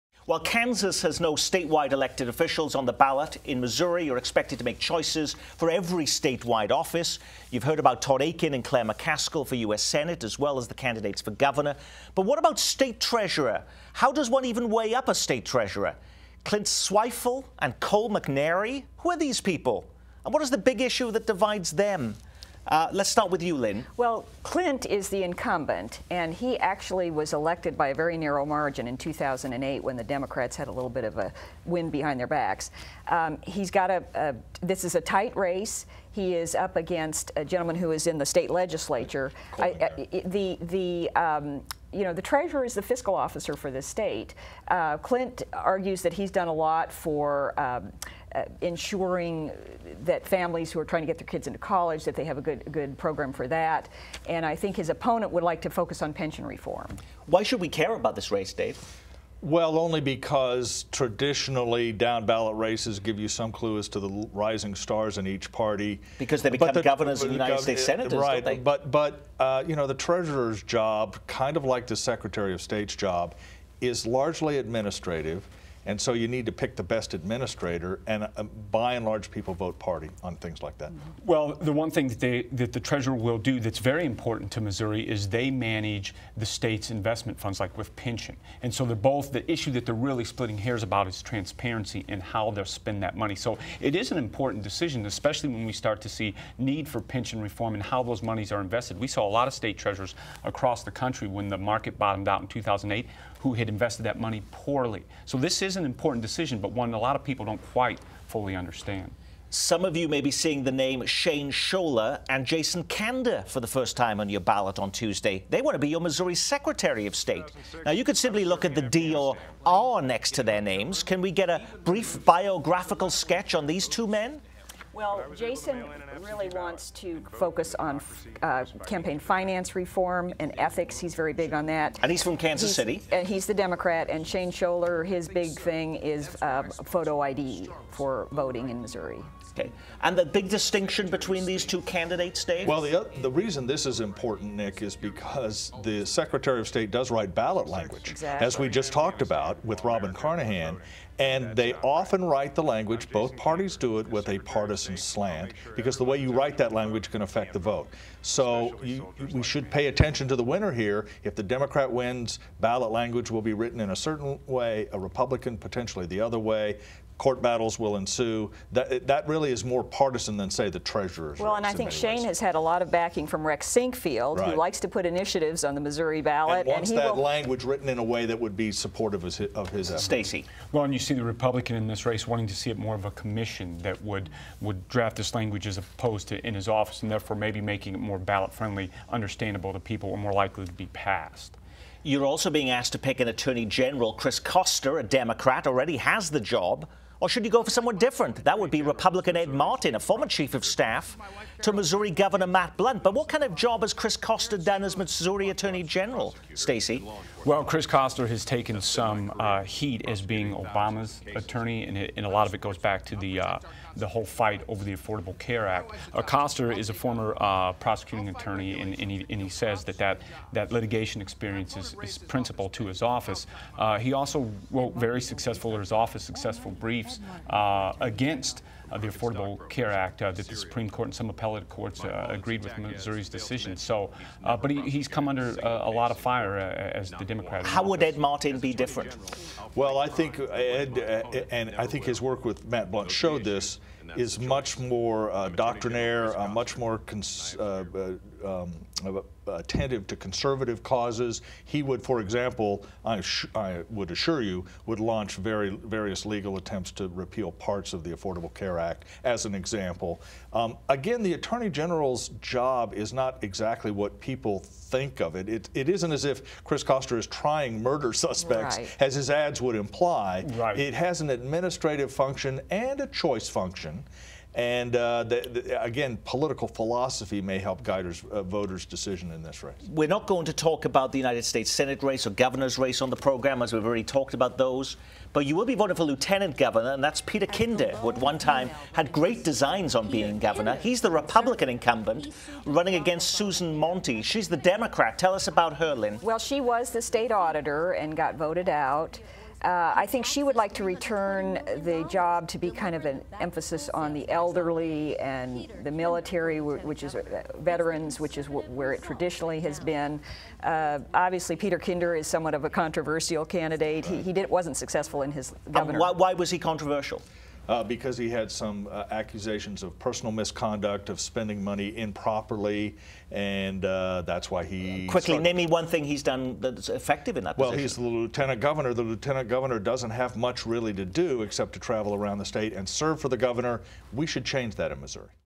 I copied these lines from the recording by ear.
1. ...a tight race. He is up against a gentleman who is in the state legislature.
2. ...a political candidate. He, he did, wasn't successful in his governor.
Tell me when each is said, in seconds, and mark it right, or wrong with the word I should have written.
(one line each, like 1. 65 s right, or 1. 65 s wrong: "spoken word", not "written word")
1. 34 s right
2. 312 s wrong: "controversial", not "political".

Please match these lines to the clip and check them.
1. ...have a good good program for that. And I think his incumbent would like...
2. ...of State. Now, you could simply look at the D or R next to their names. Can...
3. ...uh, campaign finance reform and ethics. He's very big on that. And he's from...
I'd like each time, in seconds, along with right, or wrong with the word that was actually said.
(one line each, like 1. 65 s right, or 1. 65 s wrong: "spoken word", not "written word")
1. 52 s wrong: "opponent", not "incumbent"
2. 117 s right
3. 128 s right.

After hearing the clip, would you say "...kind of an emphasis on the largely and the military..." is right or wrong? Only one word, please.
wrong.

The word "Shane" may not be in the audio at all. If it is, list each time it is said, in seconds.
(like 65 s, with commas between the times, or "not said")
111 s, 134 s, 171 s.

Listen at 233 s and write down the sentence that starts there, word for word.
So, uh, but he, he's come under a lot of fire as the Democrat.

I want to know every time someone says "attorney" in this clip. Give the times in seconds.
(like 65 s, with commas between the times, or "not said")
193 s, 205 s, 211 s, 218 s, 261 s.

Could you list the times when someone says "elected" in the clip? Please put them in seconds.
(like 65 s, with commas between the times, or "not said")
1 s, 27 s.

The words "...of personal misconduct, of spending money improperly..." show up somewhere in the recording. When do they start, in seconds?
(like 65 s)
319 s.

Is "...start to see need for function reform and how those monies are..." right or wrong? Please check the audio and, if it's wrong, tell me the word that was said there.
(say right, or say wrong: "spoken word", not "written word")
wrong: "pension", not "function".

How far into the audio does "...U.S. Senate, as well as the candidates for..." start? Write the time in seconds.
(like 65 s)
9 s.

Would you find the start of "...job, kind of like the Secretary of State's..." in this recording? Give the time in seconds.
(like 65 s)
70 s.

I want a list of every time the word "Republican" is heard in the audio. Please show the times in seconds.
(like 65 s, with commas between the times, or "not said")
164 s, 181 s, 198 s, 291 s.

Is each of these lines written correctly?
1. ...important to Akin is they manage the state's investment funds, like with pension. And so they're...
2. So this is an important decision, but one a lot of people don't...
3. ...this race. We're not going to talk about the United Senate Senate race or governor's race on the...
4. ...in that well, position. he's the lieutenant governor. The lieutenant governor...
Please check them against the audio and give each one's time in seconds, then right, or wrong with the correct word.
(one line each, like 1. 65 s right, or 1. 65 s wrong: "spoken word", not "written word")
1. 84 s wrong: "Missouri", not "Akin"
2. 105 s right
3. 279 s wrong: "States", not "Senate"
4. 327 s right.